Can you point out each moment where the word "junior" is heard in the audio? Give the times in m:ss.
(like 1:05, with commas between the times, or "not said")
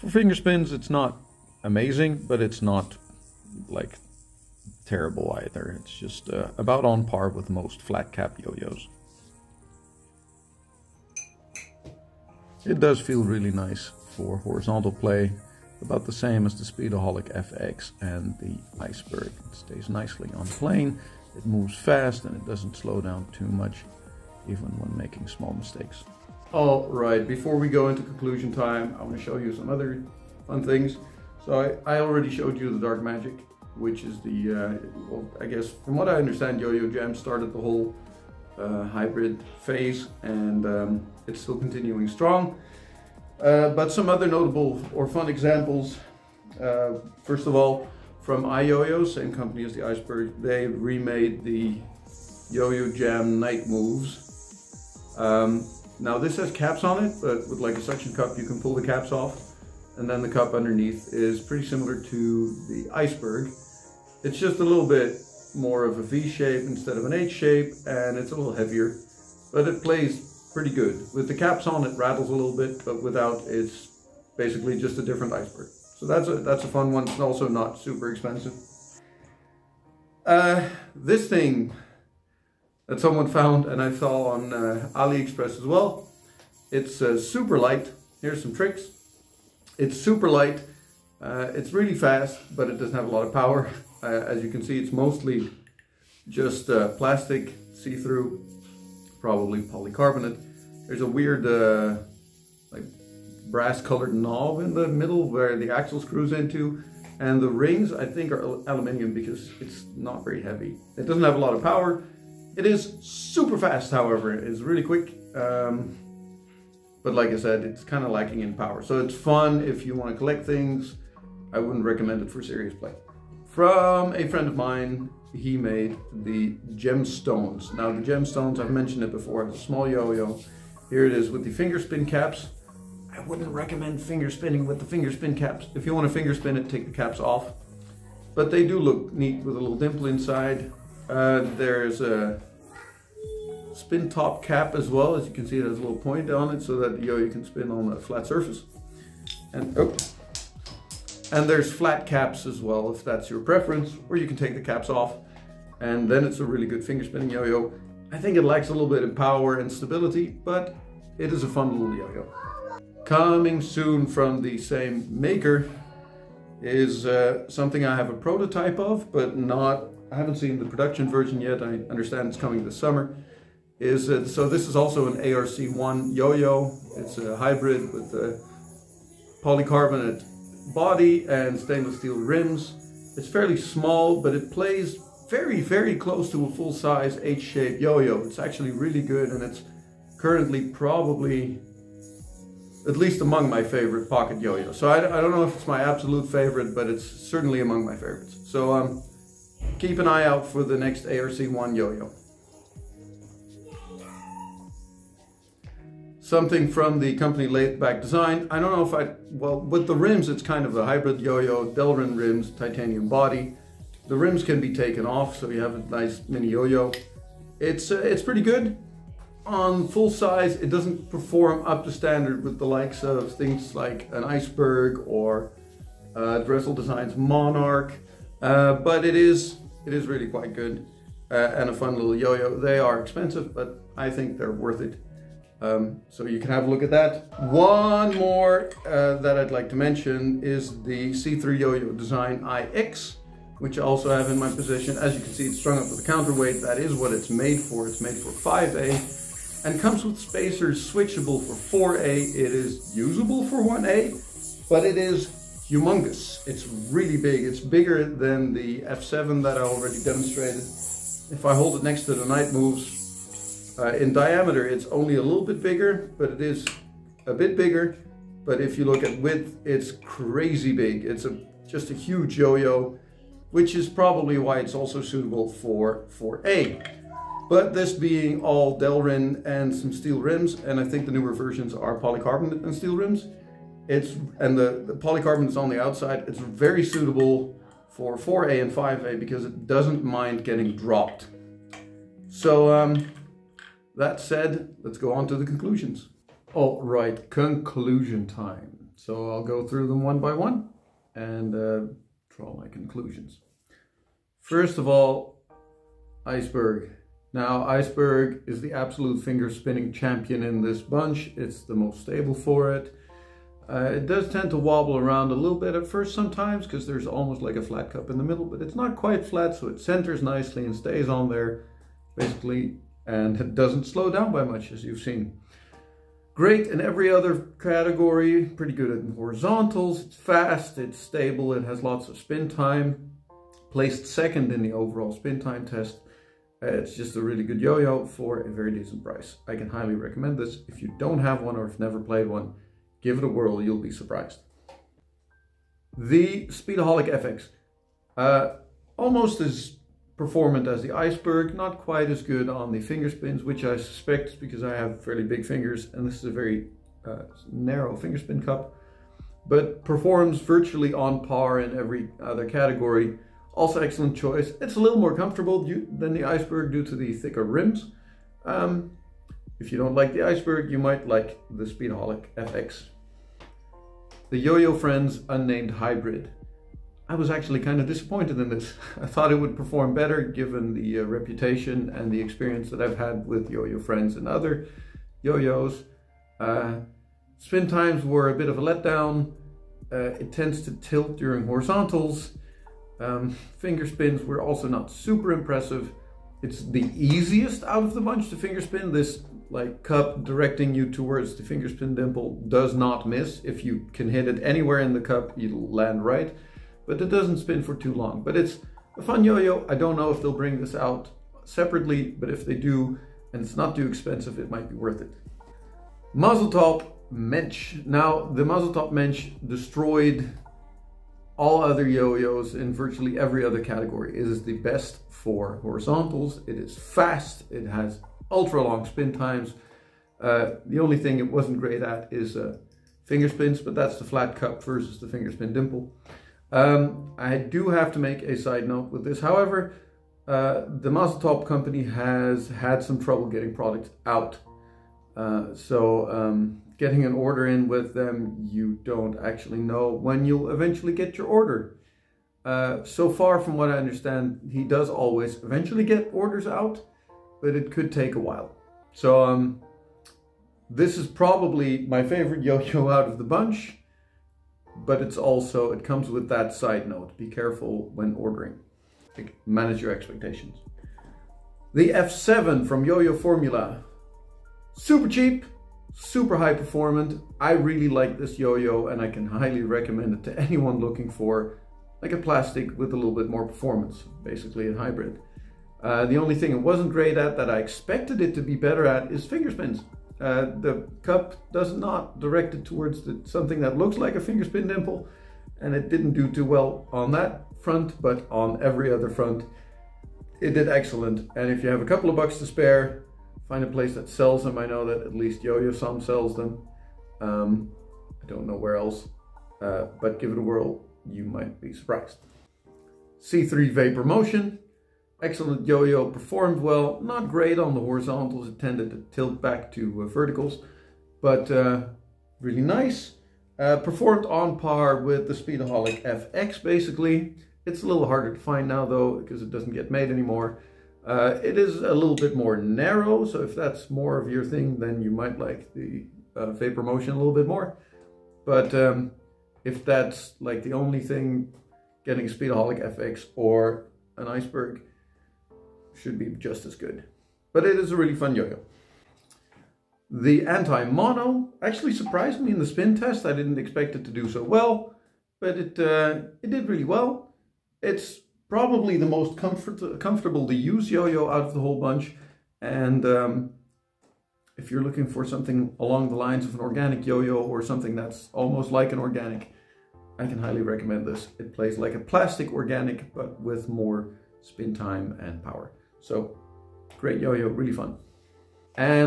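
not said.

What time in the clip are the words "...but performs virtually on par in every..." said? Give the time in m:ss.
5:59.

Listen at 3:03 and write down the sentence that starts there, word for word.
It's fairly small, but it plays very, very close to a full-size H-shaped yo-yo.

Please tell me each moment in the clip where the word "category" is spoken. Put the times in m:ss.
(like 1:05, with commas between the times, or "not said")
5:27, 6:02, 7:03.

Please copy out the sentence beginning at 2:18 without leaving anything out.
But they do look neat with a little dimple inside.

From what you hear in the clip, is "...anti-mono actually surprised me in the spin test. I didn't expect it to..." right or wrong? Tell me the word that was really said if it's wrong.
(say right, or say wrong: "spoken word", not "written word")
right.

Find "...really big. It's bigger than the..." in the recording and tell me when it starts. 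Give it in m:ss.
4:16.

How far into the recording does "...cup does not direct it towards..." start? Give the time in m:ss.
8:11.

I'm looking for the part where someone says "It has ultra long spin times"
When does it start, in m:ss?
7:07.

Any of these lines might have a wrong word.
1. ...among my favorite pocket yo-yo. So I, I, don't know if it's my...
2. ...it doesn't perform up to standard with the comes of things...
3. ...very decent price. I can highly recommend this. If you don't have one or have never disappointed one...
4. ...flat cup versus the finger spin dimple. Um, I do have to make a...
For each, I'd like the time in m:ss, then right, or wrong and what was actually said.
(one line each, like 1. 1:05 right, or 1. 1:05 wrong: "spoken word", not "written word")
1. 3:13 right
2. 3:40 wrong: "likes", not "comes"
3. 5:38 wrong: "played", not "disappointed"
4. 7:14 right.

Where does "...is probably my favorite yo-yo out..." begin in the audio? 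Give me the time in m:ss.
7:40.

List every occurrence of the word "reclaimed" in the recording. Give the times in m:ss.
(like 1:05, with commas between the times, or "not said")
not said.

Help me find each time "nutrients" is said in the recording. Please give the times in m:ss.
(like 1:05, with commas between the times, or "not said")
not said.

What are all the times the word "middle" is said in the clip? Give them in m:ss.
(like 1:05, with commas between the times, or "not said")
1:44, 5:18.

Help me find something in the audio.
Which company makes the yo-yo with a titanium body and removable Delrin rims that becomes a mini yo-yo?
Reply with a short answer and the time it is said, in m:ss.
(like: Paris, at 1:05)
Latheback Design, at 3:27.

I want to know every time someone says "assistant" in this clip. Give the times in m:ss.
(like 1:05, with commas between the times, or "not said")
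not said.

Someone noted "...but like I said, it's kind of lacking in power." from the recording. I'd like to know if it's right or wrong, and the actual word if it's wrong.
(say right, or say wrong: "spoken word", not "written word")
right.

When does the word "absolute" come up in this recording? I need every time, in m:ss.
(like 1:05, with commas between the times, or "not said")
3:15, 5:08.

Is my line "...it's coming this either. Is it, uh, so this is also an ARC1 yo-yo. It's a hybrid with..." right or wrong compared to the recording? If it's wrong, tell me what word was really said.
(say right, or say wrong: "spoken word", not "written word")
wrong: "summer", not "either".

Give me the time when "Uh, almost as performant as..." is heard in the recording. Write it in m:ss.
5:48.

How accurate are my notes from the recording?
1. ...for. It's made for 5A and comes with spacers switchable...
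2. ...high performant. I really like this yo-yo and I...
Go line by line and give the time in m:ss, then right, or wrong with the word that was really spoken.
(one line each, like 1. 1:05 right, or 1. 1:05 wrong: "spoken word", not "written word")
1. 4:07 right
2. 7:56 right.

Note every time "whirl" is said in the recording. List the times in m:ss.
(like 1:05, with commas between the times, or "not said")
5:43, 8:30.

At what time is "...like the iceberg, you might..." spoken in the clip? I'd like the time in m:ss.
6:09.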